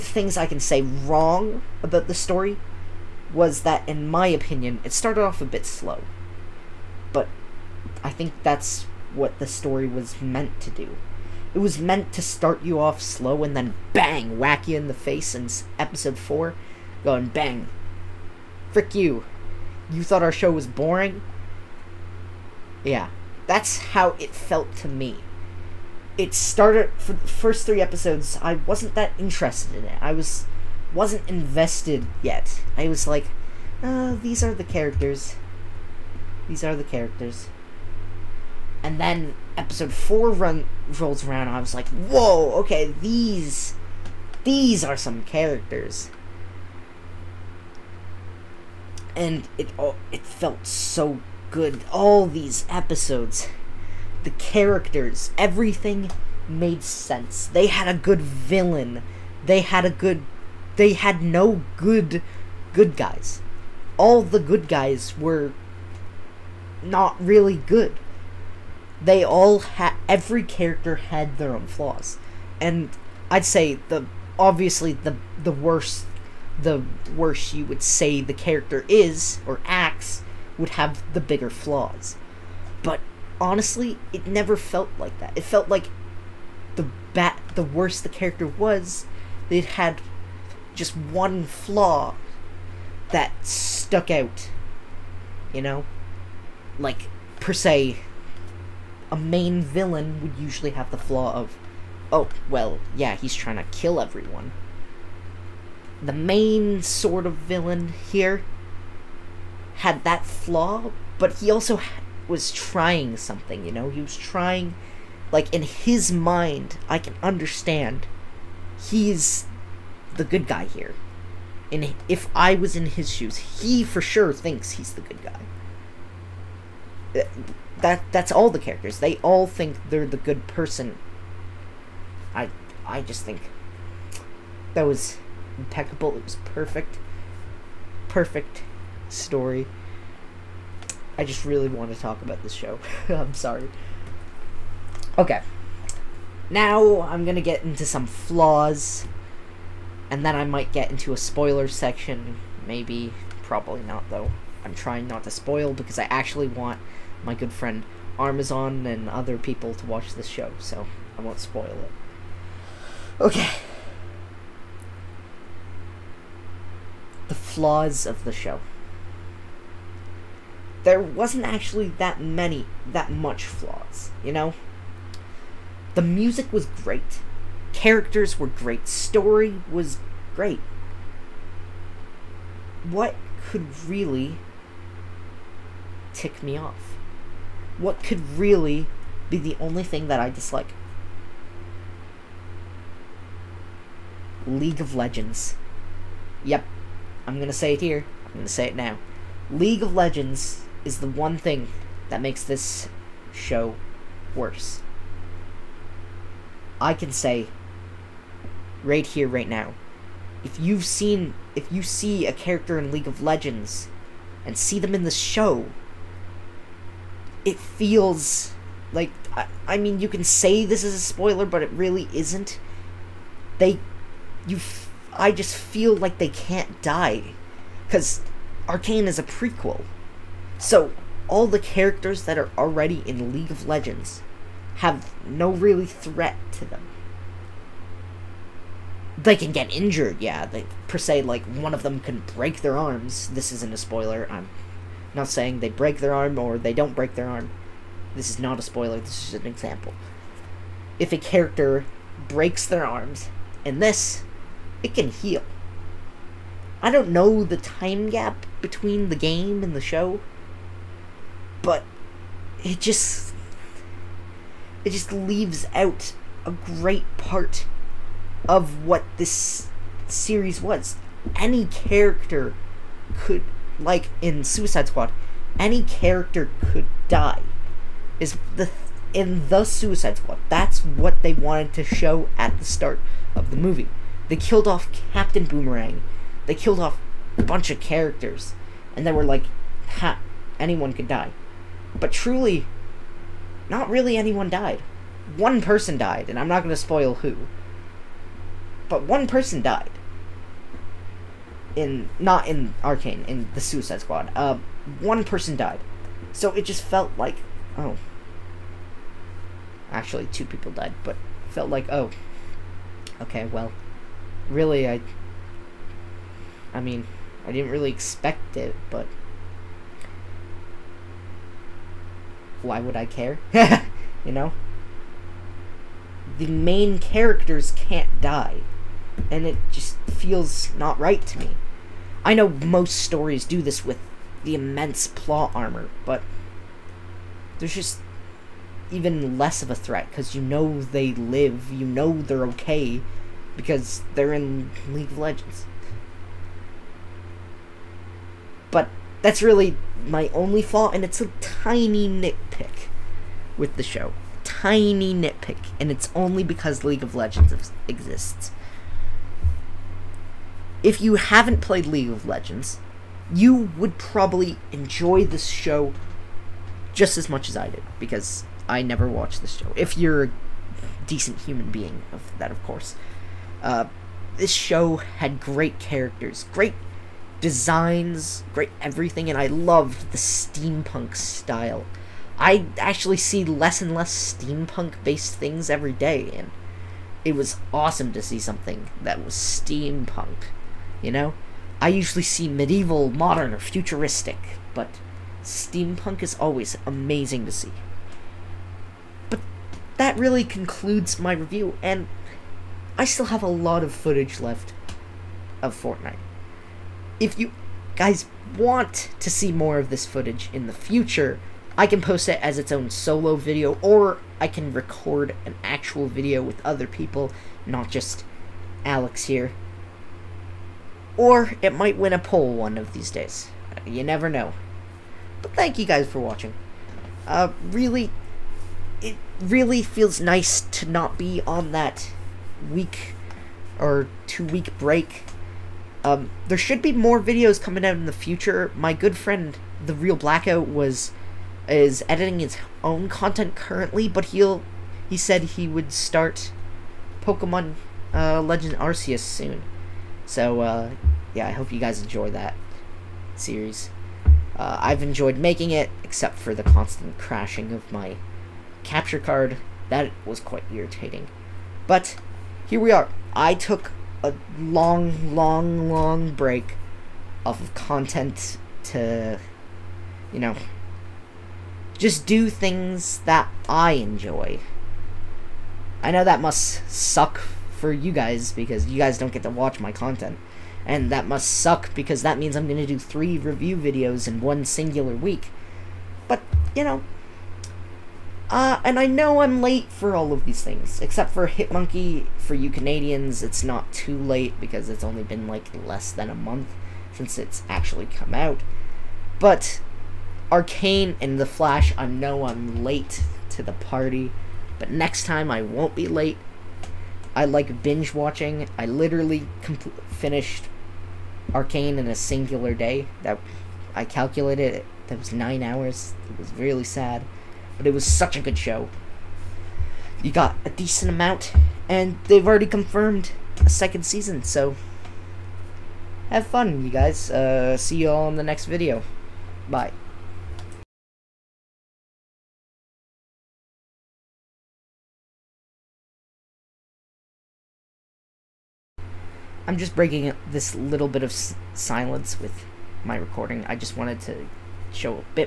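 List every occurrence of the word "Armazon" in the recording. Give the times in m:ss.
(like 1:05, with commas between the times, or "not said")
2:38.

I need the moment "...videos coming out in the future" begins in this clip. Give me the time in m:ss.
7:17.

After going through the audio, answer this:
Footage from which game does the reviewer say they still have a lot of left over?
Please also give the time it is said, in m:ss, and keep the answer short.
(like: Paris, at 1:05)
Fortnite, at 6:45.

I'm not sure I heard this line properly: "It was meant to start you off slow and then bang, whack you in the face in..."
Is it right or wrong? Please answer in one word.
right.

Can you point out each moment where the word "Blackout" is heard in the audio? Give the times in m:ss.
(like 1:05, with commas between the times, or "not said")
7:20.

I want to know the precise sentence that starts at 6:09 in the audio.
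If you're a decent human being, of that, of course.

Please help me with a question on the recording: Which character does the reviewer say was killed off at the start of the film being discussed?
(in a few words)
Captain Boomerang.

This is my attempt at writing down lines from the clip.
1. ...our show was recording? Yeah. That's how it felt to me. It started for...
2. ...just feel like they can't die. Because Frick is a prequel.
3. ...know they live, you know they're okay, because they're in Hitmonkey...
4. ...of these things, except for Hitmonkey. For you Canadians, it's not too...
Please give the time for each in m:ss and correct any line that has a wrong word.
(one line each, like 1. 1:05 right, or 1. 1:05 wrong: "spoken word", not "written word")
1. 0:20 wrong: "boring", not "recording"
2. 3:45 wrong: "Arcane", not "Frick"
3. 5:40 wrong: "League", not "Hitmonkey"
4. 8:10 right.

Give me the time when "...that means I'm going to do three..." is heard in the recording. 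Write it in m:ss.
8:02.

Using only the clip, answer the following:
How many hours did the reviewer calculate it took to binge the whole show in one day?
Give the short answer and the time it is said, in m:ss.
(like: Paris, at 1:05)
9, at 8:35.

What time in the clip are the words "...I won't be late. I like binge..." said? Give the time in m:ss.
8:25.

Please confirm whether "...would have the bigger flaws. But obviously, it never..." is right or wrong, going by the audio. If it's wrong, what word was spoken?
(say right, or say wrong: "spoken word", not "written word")
wrong: "honestly", not "obviously".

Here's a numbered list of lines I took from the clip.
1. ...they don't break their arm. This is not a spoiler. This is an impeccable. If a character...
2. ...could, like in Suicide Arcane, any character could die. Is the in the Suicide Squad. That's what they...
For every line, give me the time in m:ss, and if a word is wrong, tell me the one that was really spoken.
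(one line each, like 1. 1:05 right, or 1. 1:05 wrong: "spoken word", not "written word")
1. 4:06 wrong: "example", not "impeccable"
2. 4:33 wrong: "Squad", not "Arcane".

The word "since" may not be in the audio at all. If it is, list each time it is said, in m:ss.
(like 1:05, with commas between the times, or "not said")
8:17.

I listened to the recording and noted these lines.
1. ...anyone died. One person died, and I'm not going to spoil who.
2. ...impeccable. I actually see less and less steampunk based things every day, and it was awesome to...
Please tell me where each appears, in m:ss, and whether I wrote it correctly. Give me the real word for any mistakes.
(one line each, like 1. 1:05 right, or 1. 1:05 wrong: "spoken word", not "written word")
1. 4:54 right
2. 6:21 wrong: "style", not "impeccable".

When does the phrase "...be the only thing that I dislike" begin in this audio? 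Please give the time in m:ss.
3:09.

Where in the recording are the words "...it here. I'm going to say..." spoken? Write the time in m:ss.
3:17.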